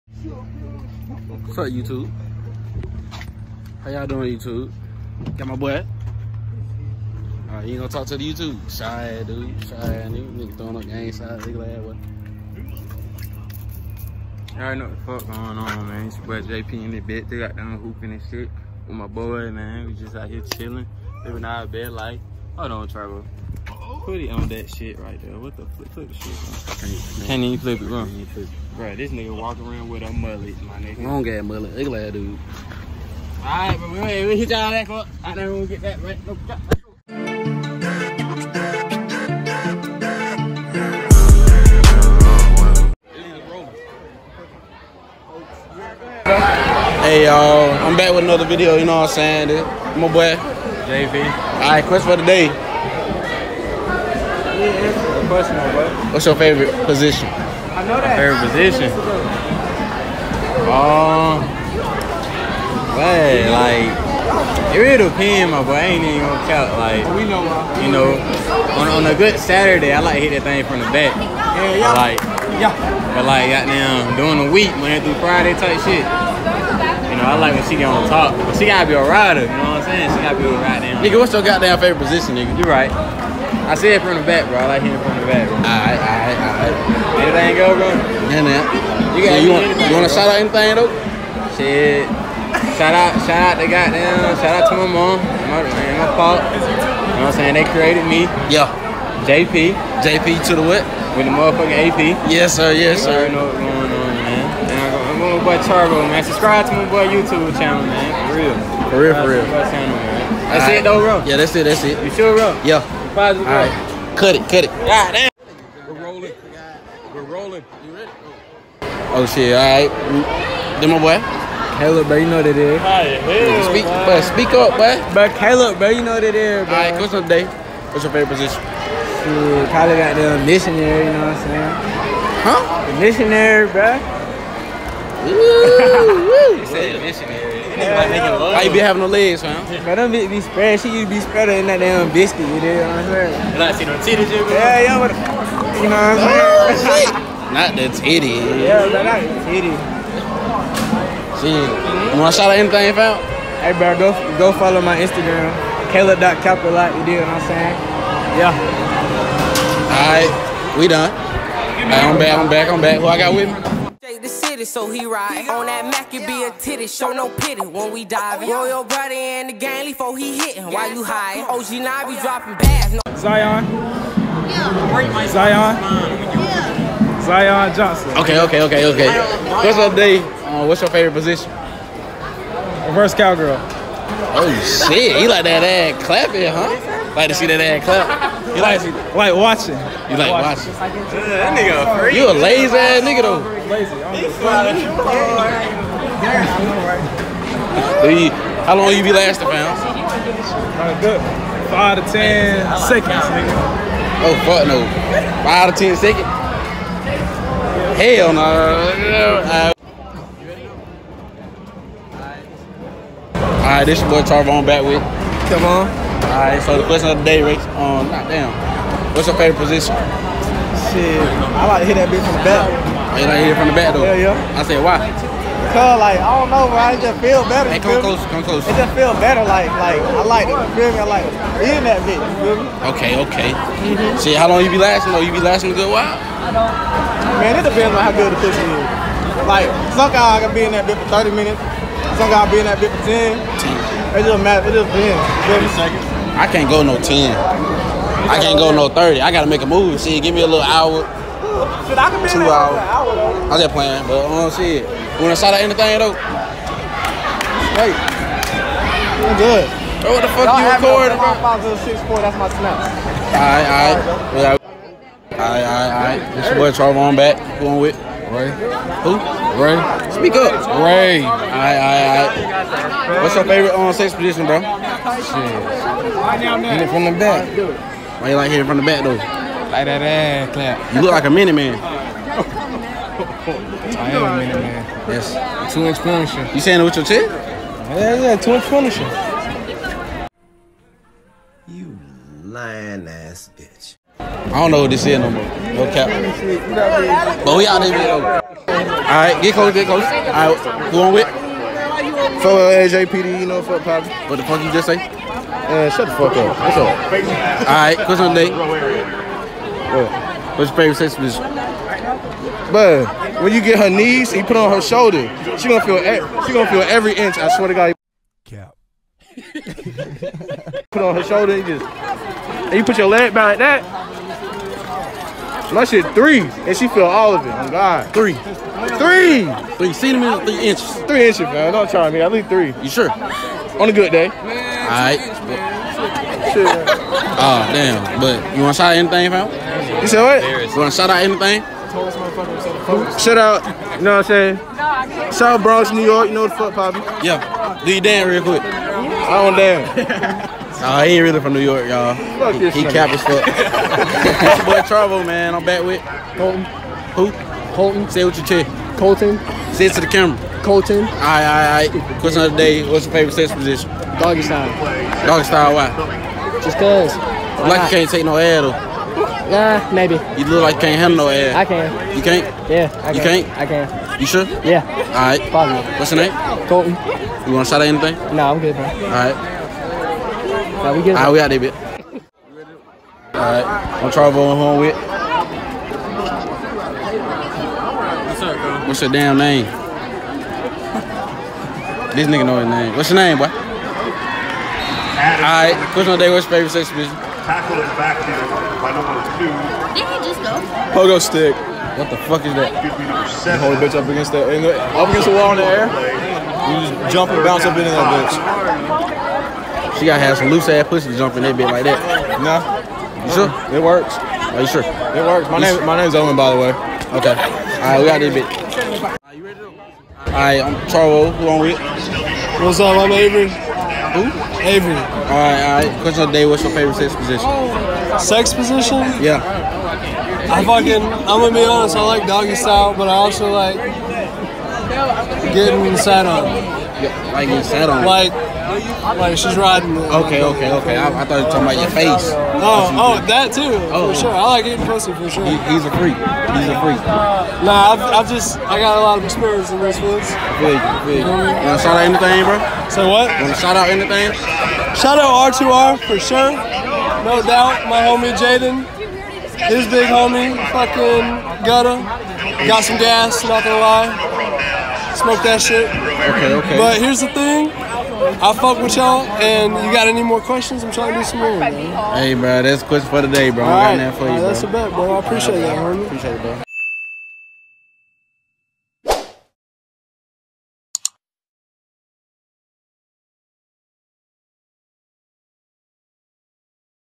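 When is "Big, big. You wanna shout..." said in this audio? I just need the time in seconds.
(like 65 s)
450 s.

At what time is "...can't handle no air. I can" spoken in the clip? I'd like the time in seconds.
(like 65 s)
370 s.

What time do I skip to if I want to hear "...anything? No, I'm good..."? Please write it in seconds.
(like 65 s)
377 s.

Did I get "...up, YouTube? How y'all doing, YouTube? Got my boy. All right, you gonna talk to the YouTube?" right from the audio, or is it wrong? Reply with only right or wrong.
right.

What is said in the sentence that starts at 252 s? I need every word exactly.
Hour, I just playing, but it.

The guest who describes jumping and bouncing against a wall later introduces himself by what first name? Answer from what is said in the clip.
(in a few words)
Owen.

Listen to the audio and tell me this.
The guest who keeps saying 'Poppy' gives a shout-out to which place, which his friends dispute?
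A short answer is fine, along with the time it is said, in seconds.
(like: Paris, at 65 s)
Bronx, New York, at 345 s.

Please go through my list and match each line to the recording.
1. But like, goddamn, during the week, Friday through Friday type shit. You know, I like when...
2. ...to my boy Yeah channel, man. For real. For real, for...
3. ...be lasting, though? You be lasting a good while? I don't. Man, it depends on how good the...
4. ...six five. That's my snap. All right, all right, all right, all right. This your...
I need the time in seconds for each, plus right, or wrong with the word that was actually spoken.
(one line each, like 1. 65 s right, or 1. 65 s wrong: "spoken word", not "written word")
1. 73 s wrong: "Monday", not "Friday"
2. 106 s wrong: "YouTube", not "Yeah"
3. 234 s right
4. 261 s wrong: "four", not "five".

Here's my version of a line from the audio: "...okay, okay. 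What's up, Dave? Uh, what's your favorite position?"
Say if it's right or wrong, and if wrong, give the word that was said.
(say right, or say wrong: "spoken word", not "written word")
right.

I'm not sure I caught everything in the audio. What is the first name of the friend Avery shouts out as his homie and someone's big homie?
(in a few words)
Jaden.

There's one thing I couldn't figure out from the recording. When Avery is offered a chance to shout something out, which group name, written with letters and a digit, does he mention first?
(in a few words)
R2R.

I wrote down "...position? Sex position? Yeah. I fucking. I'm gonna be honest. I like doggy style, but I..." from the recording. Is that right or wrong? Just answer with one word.
right.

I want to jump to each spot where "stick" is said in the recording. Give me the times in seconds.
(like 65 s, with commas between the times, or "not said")
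401 s.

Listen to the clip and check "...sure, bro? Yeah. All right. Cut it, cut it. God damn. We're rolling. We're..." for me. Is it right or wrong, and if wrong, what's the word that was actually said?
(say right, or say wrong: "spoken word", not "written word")
right.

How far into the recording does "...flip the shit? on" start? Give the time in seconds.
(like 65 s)
25 s.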